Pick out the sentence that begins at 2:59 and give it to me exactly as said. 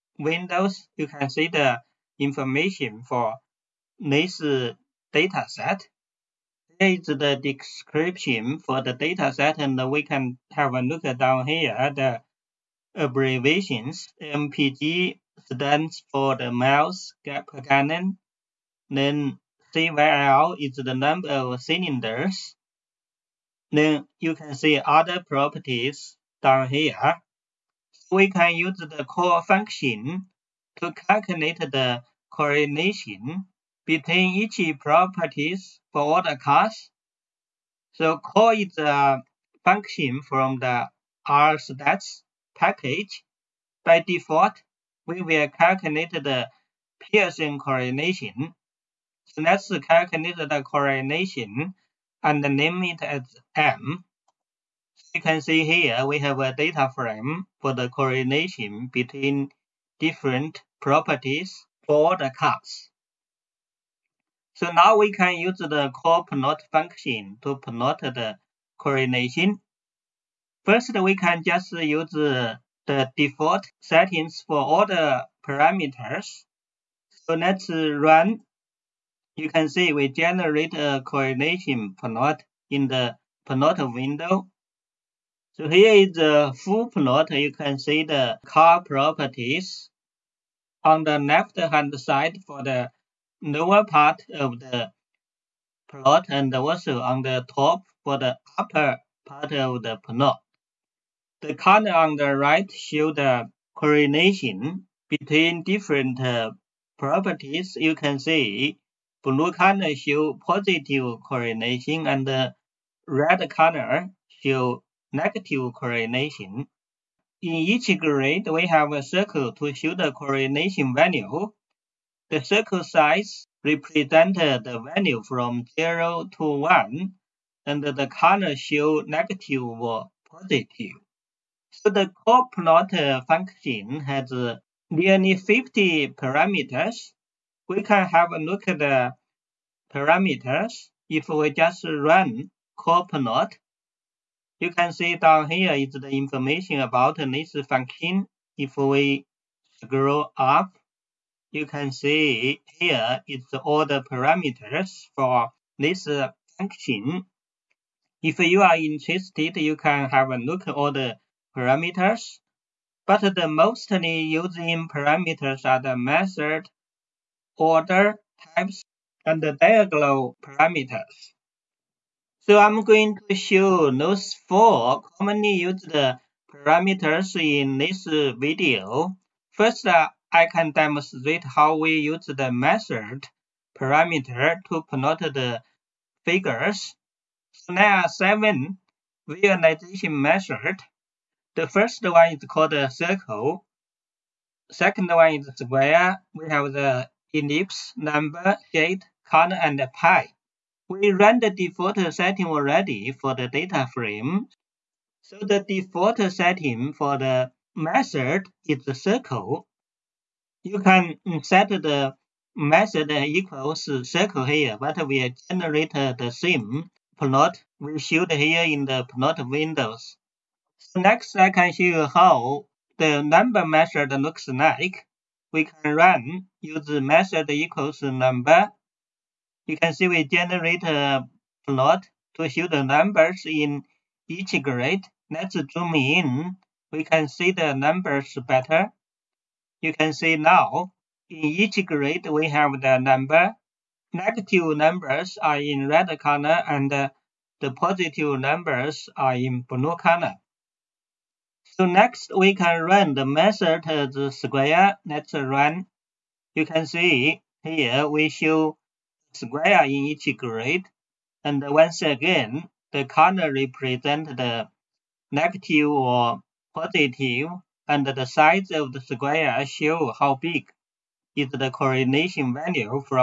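First, uh, I can demonstrate how we use the method parameter to plot the figures.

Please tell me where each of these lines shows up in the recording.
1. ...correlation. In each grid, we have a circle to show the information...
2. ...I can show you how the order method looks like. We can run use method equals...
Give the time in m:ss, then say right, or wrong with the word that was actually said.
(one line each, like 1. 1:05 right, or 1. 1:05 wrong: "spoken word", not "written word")
1. 1:55 wrong: "correlation", not "information"
2. 3:41 wrong: "number", not "order".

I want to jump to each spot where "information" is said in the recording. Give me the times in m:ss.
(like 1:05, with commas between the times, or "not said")
0:02, 2:26.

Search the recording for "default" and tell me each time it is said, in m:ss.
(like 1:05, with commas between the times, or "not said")
0:44, 1:13, 3:21, 3:25.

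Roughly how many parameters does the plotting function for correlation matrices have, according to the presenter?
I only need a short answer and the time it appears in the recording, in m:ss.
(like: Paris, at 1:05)
Nearly 50, at 2:14.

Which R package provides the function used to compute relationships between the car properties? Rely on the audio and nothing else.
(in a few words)
stats.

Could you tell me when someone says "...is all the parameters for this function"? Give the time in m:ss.
2:33.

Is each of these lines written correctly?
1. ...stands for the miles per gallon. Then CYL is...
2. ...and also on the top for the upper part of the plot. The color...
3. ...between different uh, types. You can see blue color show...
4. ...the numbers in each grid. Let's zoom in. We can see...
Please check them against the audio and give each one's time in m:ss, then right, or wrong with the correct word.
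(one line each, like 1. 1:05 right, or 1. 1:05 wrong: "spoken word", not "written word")
1. 0:15 right
2. 1:36 right
3. 1:45 wrong: "properties", not "types"
4. 3:52 right.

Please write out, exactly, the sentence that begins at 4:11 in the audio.
So next, we can run the method the square.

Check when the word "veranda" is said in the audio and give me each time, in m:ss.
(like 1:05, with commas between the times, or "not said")
not said.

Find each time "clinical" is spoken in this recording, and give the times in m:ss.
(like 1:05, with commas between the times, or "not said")
not said.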